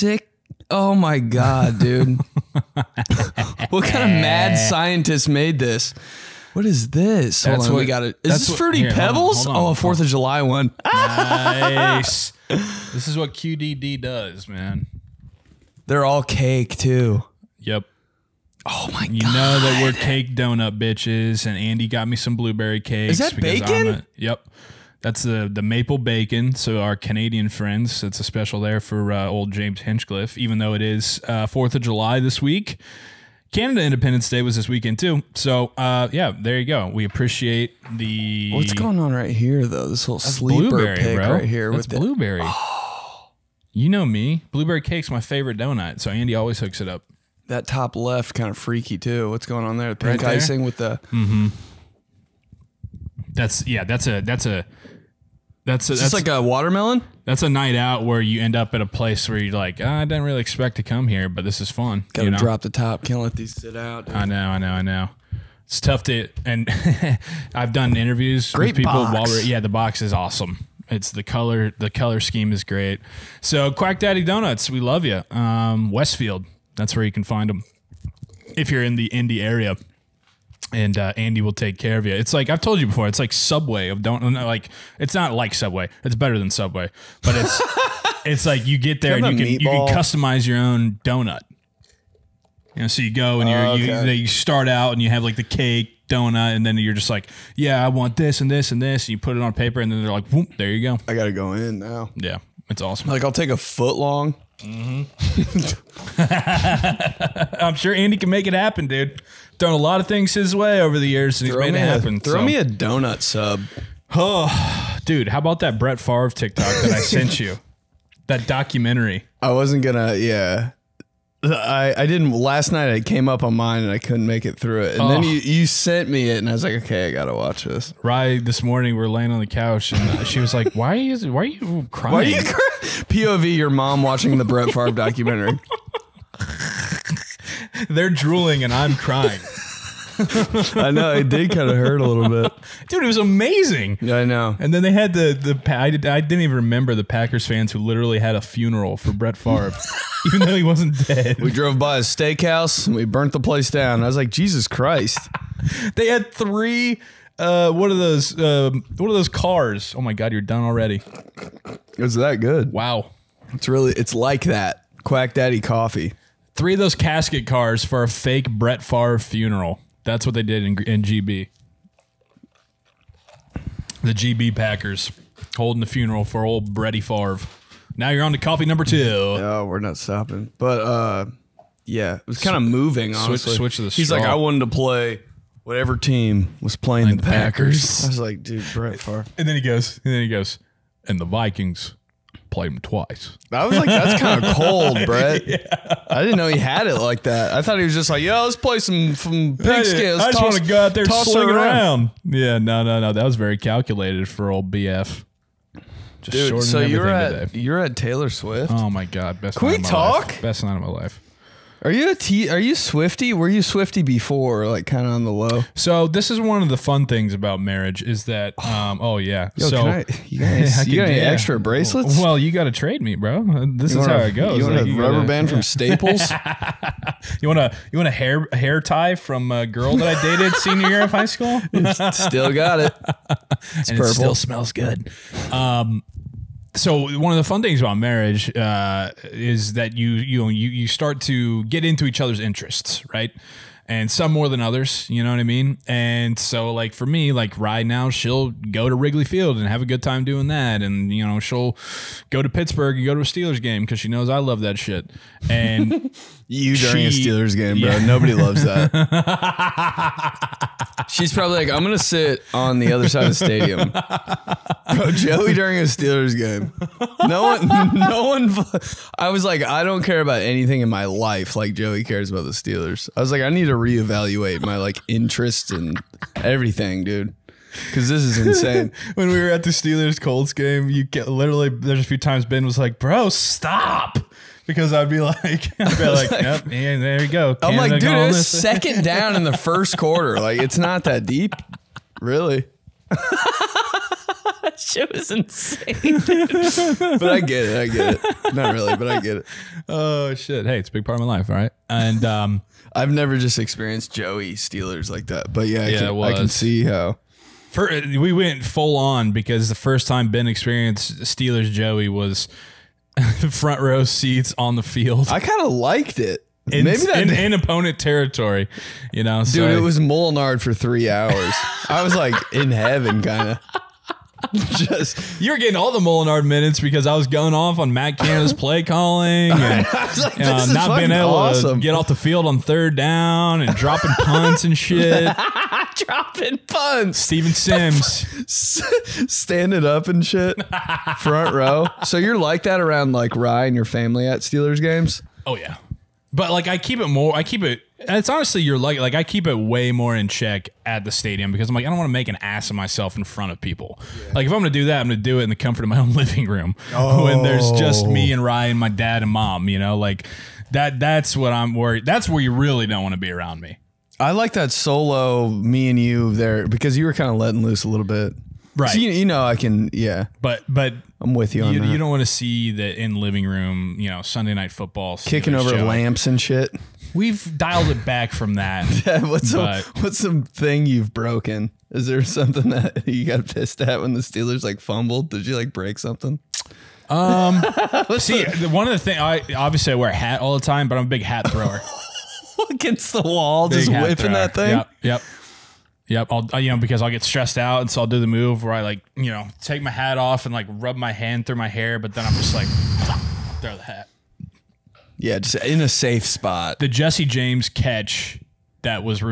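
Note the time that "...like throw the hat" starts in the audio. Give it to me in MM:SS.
06:42.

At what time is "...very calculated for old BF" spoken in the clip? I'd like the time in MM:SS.
03:23.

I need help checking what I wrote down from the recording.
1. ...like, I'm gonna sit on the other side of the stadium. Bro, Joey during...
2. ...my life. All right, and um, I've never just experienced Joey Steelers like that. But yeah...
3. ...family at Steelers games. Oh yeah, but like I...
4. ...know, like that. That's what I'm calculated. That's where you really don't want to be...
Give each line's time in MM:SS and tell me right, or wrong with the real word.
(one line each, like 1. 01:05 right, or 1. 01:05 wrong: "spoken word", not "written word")
1. 04:21 right
2. 05:01 right
3. 05:43 right
4. 05:59 wrong: "worried", not "calculated".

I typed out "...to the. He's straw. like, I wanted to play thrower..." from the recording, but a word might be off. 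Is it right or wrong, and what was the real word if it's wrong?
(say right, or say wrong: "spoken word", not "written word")
wrong: "whatever", not "thrower".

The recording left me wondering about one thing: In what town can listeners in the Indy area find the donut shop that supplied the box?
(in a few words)
Westfield.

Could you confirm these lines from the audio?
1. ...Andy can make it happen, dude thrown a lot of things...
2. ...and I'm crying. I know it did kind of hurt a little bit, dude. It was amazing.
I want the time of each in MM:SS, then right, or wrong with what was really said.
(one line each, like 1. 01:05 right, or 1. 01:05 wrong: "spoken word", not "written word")
1. 01:47 right
2. 02:18 right.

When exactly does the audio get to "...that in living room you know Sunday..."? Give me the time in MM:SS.
06:12.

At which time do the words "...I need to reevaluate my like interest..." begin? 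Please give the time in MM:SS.
04:33.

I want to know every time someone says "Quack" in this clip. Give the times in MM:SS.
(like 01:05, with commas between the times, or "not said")
01:13, 02:45.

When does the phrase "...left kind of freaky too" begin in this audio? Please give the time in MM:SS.
00:47.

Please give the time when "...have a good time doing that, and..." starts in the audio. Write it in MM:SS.
04:09.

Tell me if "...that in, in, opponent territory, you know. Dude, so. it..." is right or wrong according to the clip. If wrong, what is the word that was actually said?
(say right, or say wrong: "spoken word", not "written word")
right.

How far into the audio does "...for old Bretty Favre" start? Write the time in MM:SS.
02:56.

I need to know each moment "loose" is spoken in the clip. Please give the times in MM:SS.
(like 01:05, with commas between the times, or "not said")
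06:07.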